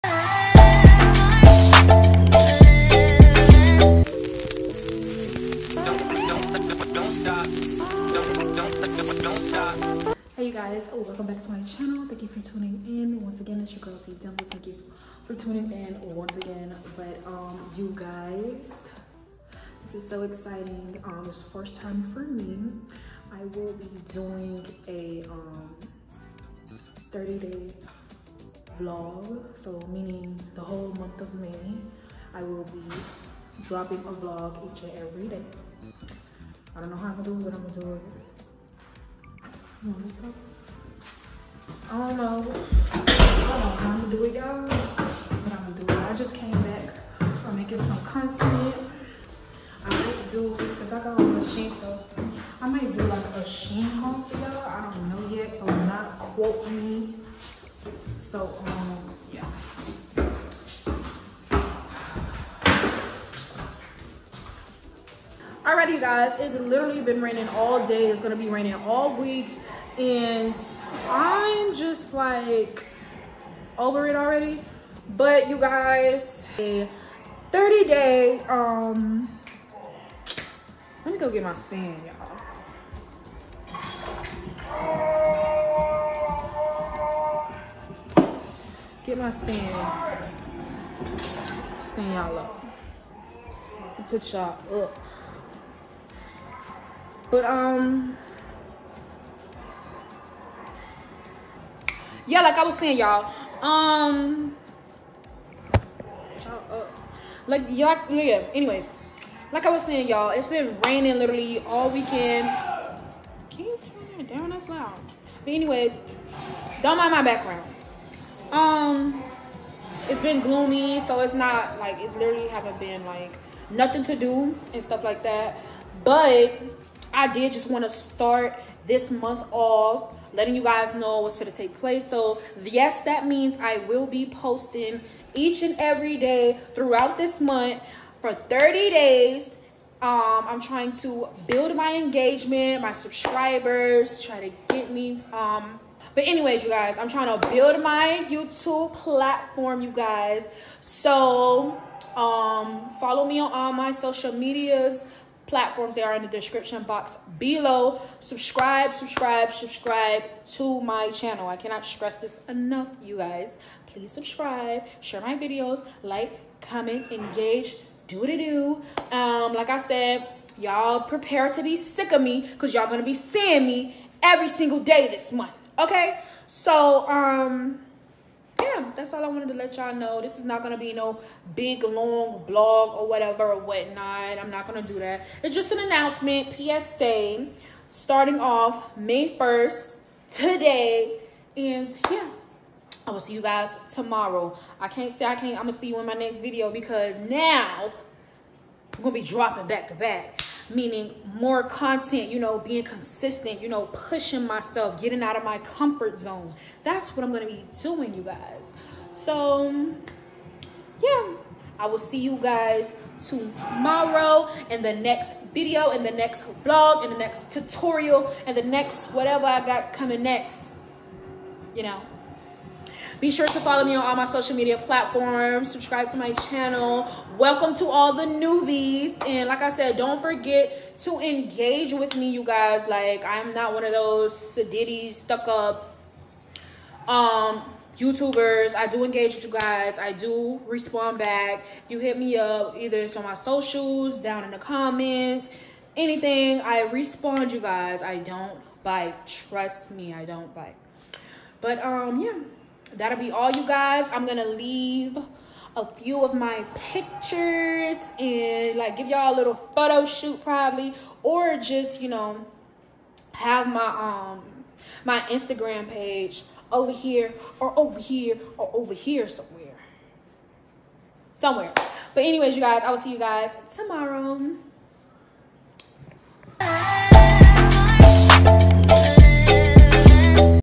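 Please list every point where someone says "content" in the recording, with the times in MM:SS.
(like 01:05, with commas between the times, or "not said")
00:48, 03:21.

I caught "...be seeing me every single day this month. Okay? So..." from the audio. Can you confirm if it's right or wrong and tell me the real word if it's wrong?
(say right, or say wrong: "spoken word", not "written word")
right.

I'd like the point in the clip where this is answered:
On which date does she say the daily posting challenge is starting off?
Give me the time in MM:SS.
03:08.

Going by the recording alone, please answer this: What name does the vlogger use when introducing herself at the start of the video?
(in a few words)
T Dimples.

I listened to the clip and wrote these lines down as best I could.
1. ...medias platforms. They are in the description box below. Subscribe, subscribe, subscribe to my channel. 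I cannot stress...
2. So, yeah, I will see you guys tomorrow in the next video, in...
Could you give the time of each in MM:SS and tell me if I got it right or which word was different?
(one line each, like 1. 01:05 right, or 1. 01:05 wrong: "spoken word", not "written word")
1. 02:34 right
2. 03:29 right.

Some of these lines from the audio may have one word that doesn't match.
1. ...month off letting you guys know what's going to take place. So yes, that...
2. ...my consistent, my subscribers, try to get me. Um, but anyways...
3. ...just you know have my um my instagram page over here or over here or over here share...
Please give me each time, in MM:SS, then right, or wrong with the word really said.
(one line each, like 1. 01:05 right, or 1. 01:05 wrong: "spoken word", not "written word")
1. 02:09 right
2. 02:21 wrong: "engagement", not "consistent"
3. 04:21 wrong: "somewhere", not "share".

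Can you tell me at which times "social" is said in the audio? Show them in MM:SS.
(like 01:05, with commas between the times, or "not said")
02:33, 03:44, 04:03.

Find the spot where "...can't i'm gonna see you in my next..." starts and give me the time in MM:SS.
03:15.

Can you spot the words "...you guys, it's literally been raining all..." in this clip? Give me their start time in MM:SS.
01:05.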